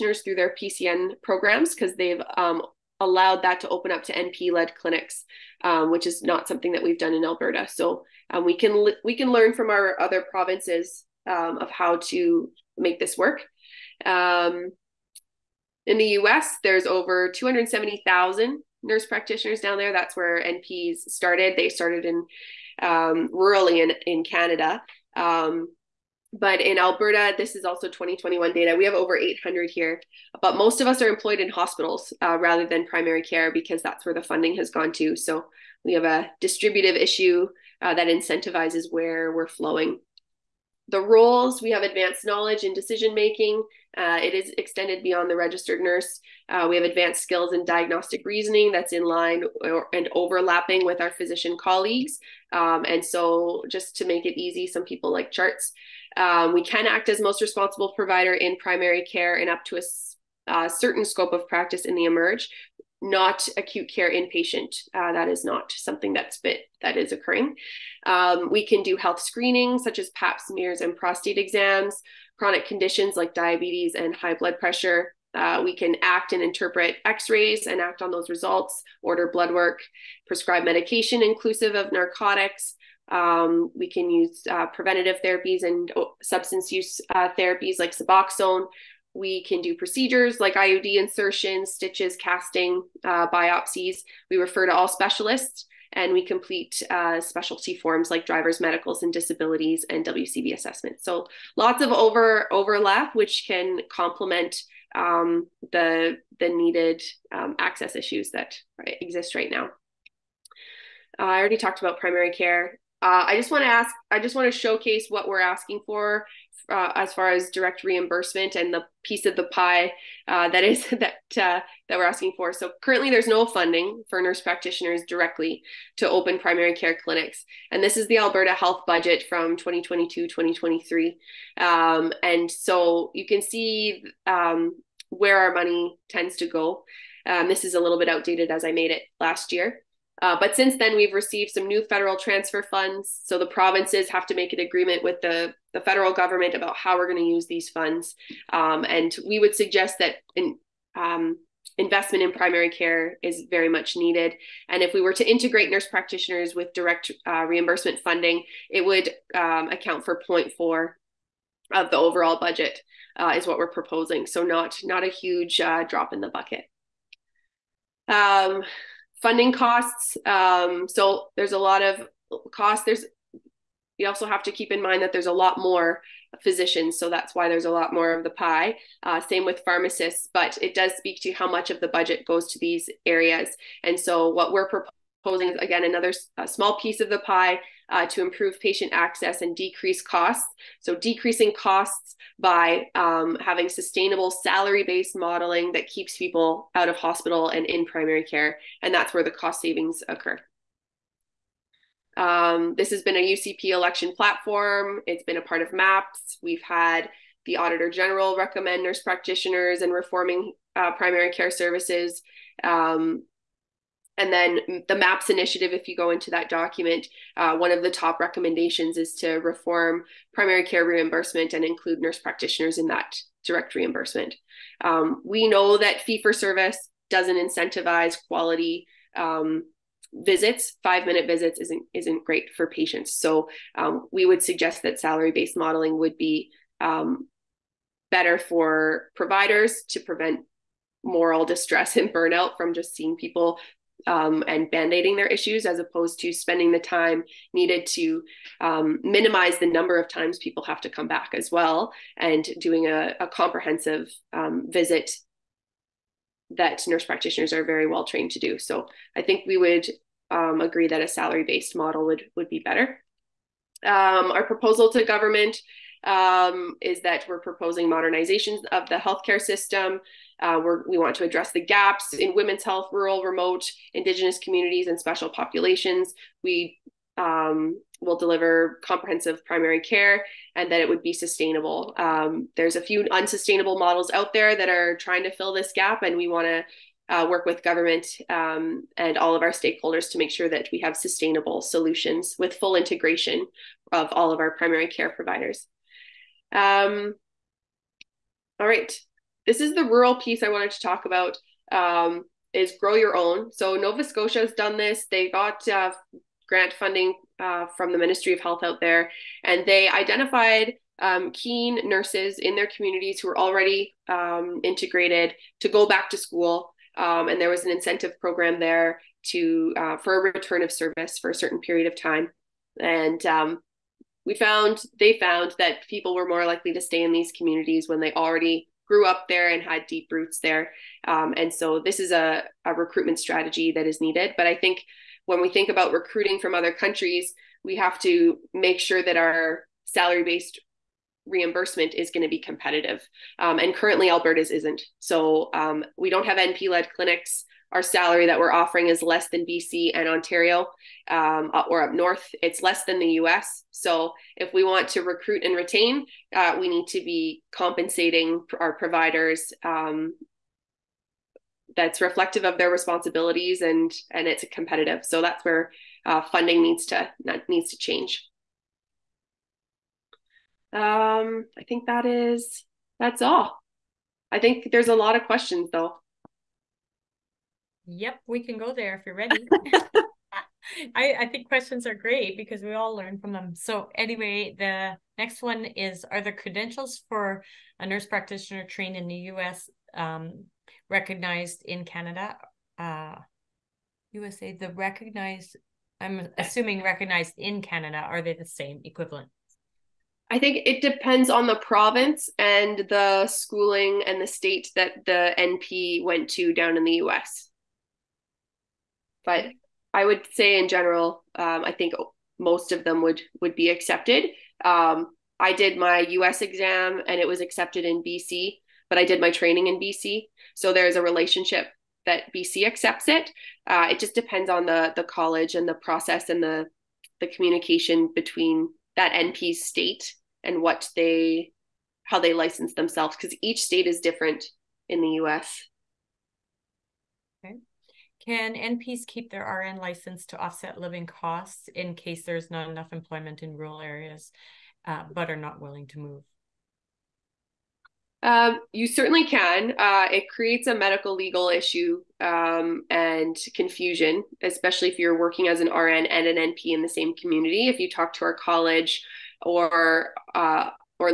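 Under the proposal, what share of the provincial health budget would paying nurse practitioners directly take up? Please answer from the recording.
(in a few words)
0.4.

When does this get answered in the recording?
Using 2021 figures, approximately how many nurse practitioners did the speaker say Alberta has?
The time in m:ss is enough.
0:28.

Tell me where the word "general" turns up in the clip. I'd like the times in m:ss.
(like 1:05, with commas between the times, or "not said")
3:27, 6:50.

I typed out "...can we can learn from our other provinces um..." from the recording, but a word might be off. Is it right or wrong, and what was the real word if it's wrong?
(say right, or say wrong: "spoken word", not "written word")
right.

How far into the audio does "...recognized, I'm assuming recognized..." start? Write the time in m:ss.
6:34.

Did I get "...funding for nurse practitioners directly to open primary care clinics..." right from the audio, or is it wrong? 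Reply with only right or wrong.
right.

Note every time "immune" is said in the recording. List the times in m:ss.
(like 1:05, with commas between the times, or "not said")
not said.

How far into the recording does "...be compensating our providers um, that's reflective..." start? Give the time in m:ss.
5:56.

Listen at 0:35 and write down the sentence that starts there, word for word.
So we have a distributive issue uh, that incentivizes where we're flowing.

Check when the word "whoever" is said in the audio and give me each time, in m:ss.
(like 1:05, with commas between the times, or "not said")
not said.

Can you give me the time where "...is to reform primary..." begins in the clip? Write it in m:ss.
3:38.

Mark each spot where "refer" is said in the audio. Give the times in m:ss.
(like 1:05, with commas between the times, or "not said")
1:34.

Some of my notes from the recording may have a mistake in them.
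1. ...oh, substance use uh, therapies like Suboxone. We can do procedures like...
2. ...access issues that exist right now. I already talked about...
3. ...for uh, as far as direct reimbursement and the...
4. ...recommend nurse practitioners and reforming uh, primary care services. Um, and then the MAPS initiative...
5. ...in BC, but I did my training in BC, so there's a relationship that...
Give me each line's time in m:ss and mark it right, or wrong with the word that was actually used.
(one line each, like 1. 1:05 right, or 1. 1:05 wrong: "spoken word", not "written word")
1. 1:25 right
2. 1:47 right
3. 1:55 right
4. 3:28 right
5. 6:57 right.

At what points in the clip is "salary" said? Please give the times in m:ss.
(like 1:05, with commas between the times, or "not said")
3:14, 3:54, 4:21, 5:39, 5:47.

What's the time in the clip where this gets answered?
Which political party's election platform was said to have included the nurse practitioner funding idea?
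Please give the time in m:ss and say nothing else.
3:23.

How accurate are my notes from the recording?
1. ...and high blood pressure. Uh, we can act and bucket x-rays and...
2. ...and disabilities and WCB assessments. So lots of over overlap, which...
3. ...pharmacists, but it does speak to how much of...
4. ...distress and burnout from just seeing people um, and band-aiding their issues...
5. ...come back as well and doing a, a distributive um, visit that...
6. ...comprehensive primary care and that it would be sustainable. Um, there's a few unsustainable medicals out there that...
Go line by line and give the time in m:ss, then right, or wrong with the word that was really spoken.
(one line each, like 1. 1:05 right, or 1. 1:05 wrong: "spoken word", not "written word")
1. 1:13 wrong: "interpret", not "bucket"
2. 1:39 right
3. 2:59 right
4. 4:01 right
5. 4:10 wrong: "comprehensive", not "distributive"
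6. 4:38 wrong: "models", not "medicals".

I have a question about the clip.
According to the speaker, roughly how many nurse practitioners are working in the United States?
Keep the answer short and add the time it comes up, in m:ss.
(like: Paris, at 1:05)
270,000, at 0:17.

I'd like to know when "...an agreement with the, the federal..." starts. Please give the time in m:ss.
2:24.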